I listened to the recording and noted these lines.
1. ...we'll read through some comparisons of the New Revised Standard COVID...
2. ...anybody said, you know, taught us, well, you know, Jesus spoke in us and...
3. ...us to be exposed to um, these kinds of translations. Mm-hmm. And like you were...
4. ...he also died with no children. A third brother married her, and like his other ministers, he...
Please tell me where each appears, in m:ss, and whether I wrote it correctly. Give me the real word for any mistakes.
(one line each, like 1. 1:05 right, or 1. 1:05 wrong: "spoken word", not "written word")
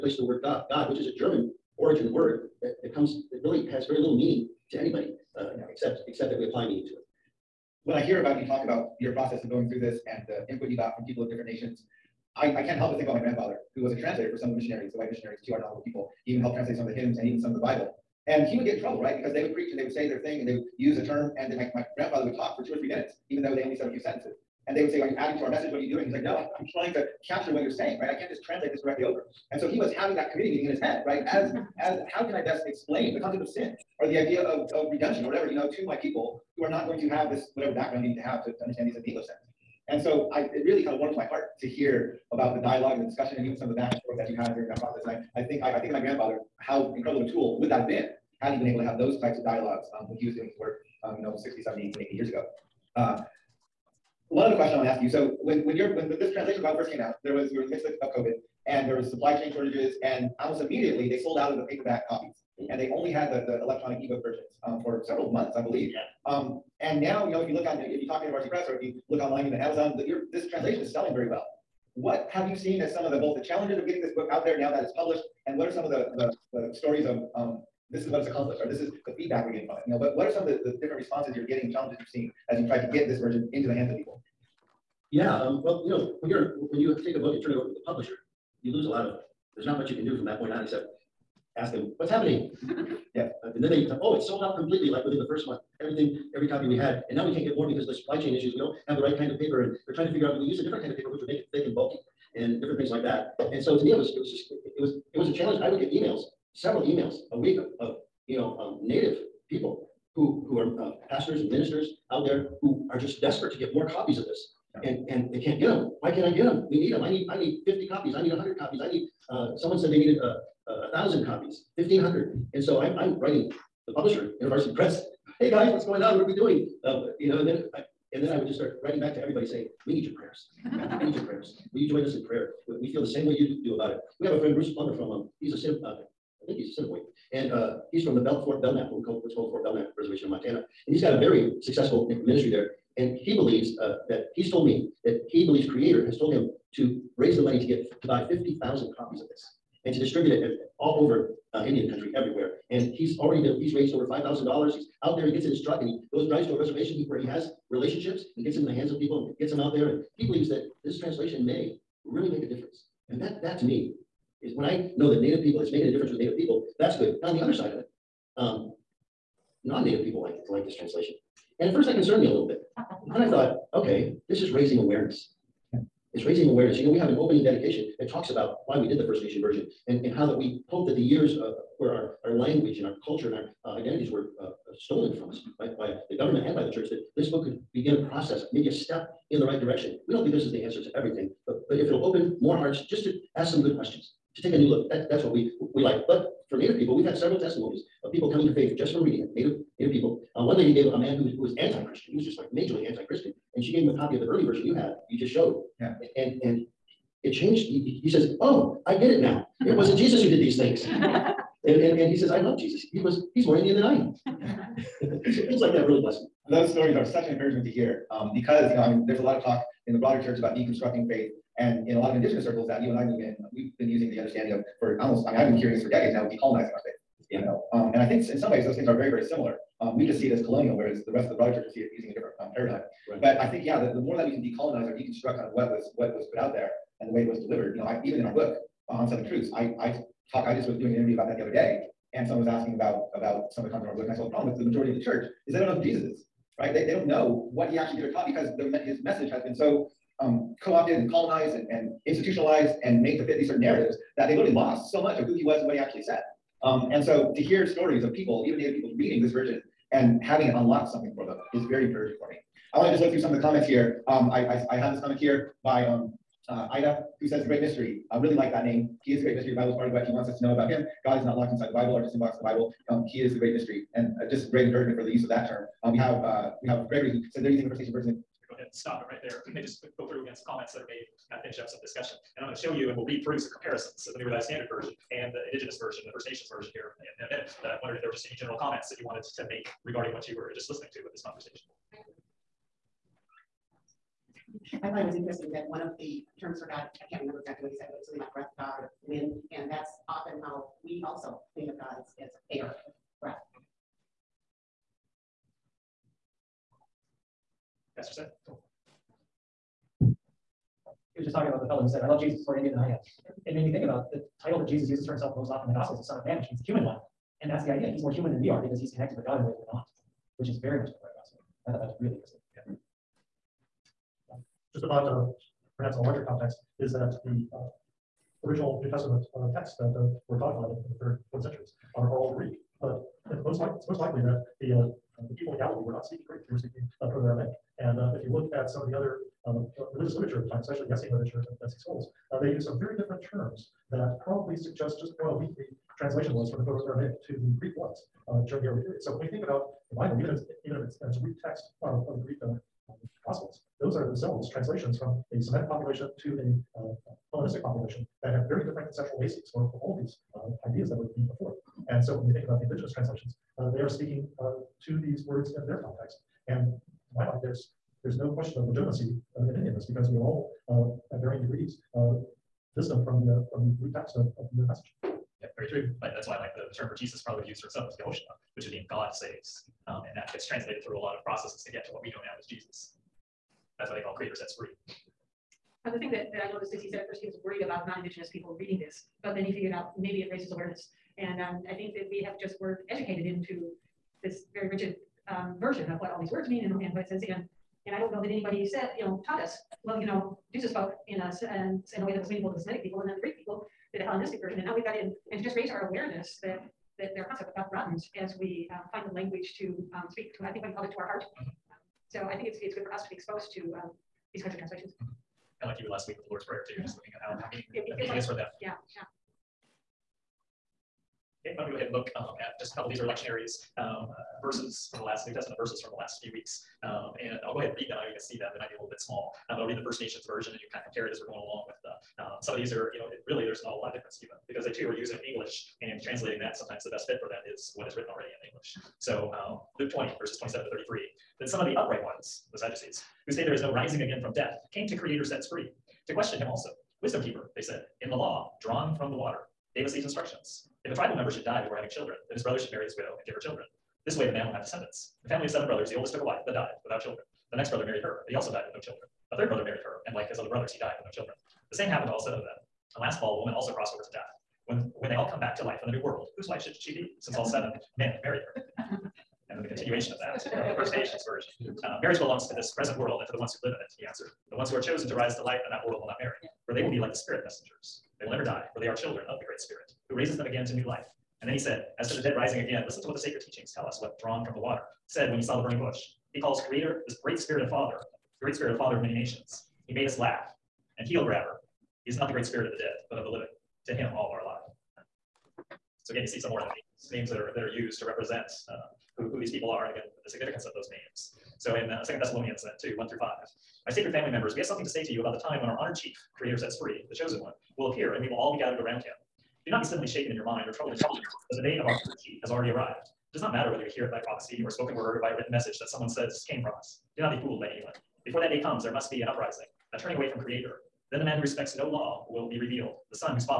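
1. 4:42 wrong: "Version", not "COVID"
2. 6:38 right
3. 6:52 right
4. 7:38 wrong: "brothers", not "ministers".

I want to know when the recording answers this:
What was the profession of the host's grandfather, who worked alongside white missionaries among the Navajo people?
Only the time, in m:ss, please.
0:14.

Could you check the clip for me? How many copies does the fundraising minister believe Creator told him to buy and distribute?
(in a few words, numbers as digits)
50,000.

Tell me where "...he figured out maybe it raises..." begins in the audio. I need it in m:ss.
6:29.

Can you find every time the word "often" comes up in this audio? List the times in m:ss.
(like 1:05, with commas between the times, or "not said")
5:00, 5:15.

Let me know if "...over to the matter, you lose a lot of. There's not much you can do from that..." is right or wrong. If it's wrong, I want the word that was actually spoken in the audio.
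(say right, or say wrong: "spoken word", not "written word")
wrong: "publisher", not "matter".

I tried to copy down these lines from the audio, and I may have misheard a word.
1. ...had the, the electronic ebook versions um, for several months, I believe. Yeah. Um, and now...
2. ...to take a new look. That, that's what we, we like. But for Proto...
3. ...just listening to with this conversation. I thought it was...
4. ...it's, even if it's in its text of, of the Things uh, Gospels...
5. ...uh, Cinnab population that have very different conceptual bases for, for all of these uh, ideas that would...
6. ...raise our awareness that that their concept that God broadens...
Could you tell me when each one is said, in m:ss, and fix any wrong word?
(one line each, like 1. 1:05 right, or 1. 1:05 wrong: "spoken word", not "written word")
1. 1:03 right
2. 3:14 wrong: "Native", not "Proto"
3. 4:50 right
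4. 5:50 wrong: "Greek", not "Things"
5. 5:56 wrong: "Hellenistic", not "Cinnab"
6. 6:45 right.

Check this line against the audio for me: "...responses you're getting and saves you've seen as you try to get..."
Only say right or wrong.
wrong.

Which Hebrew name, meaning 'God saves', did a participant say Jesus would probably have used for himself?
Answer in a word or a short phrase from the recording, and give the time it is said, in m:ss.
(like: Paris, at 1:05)
Yehoshua, at 6:17.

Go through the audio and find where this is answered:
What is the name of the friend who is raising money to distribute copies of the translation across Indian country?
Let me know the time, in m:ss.
2:14.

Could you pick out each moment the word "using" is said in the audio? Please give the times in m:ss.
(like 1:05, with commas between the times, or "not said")
3:43, 3:51, 4:37, 7:14.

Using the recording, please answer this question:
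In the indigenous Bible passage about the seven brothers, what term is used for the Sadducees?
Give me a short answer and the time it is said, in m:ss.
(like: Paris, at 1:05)
the upright ones, at 7:21.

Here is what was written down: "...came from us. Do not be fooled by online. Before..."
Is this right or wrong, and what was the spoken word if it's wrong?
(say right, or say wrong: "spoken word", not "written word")
wrong: "anyone", not "online".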